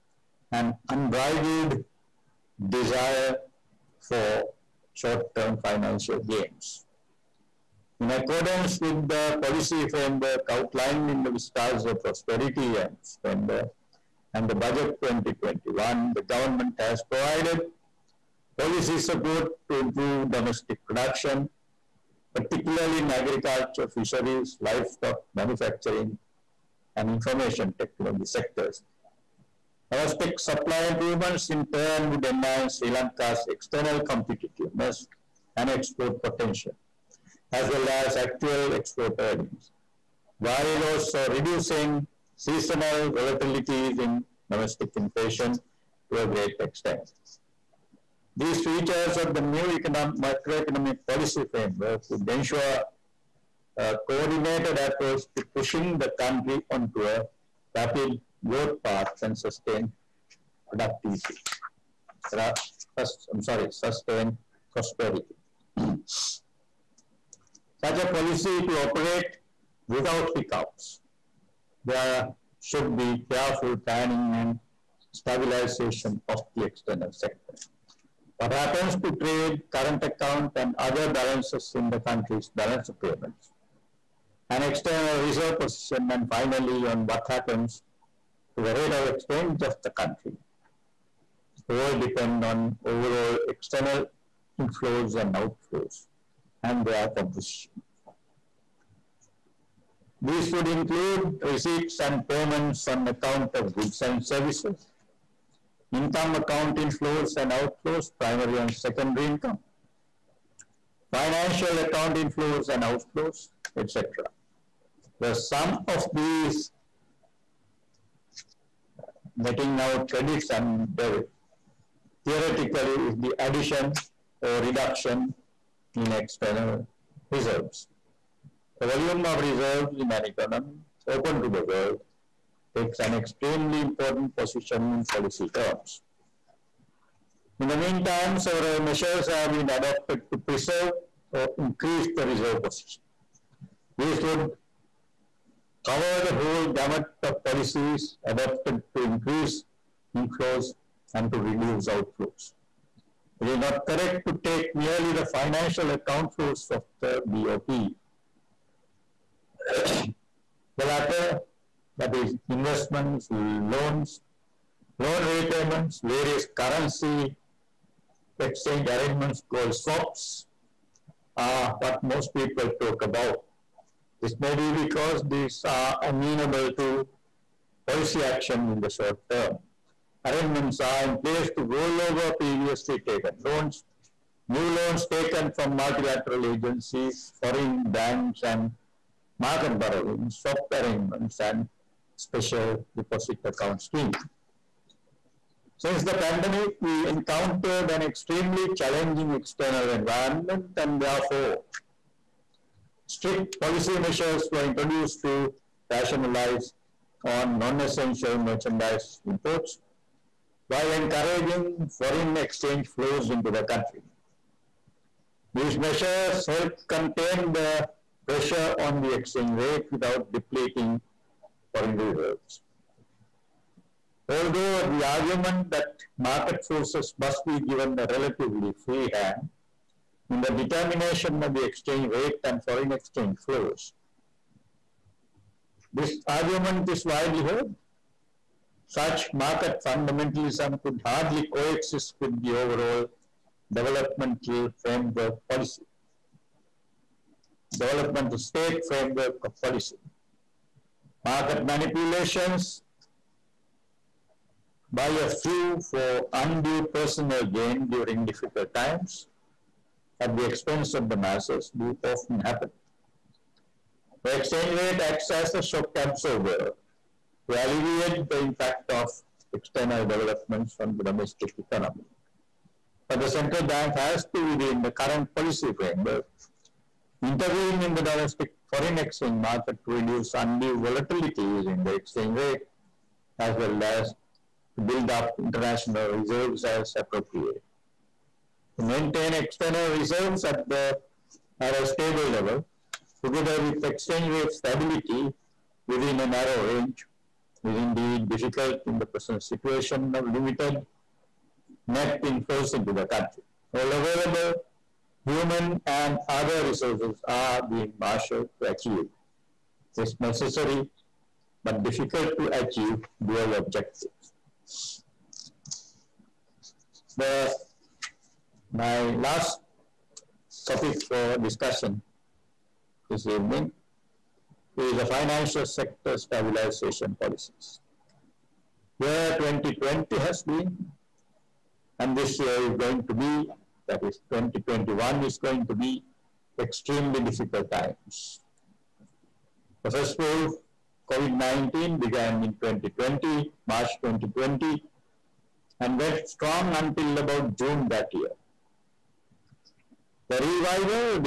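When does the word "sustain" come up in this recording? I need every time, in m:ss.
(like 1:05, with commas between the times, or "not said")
0:59, 1:03.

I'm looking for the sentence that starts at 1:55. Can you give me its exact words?
The sum of these netting out credits and debit theoretically is the addition or reduction in external reserves.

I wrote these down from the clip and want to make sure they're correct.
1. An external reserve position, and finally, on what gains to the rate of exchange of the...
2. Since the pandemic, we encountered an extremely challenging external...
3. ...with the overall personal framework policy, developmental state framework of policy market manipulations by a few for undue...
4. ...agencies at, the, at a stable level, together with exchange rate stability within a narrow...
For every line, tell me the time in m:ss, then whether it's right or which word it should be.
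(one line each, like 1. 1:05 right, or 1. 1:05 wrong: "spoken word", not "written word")
1. 1:24 wrong: "happens", not "gains"
2. 3:15 right
3. 4:02 wrong: "developmental", not "personal"
4. 4:49 wrong: "reserves", not "agencies".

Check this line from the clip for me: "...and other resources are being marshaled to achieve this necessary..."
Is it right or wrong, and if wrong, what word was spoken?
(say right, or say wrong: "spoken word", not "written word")
right.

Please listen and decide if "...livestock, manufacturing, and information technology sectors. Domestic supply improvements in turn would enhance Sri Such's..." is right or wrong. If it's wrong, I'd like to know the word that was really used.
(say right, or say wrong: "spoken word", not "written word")
wrong: "Lanka", not "Such".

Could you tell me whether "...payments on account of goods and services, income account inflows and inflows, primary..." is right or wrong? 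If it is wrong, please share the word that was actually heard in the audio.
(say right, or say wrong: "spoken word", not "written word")
wrong: "outflows", not "inflows".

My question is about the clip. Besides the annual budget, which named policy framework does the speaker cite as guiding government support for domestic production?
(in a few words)
Vistas of Prosperity and Splendour.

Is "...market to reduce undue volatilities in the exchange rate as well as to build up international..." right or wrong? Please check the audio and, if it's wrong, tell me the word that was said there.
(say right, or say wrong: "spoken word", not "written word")
right.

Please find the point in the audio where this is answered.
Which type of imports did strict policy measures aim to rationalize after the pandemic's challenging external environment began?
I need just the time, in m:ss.
3:27.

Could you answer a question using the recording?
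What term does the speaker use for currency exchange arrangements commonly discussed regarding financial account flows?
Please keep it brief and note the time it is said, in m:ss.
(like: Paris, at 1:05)
swaps, at 2:49.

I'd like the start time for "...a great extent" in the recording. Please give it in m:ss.
0:46.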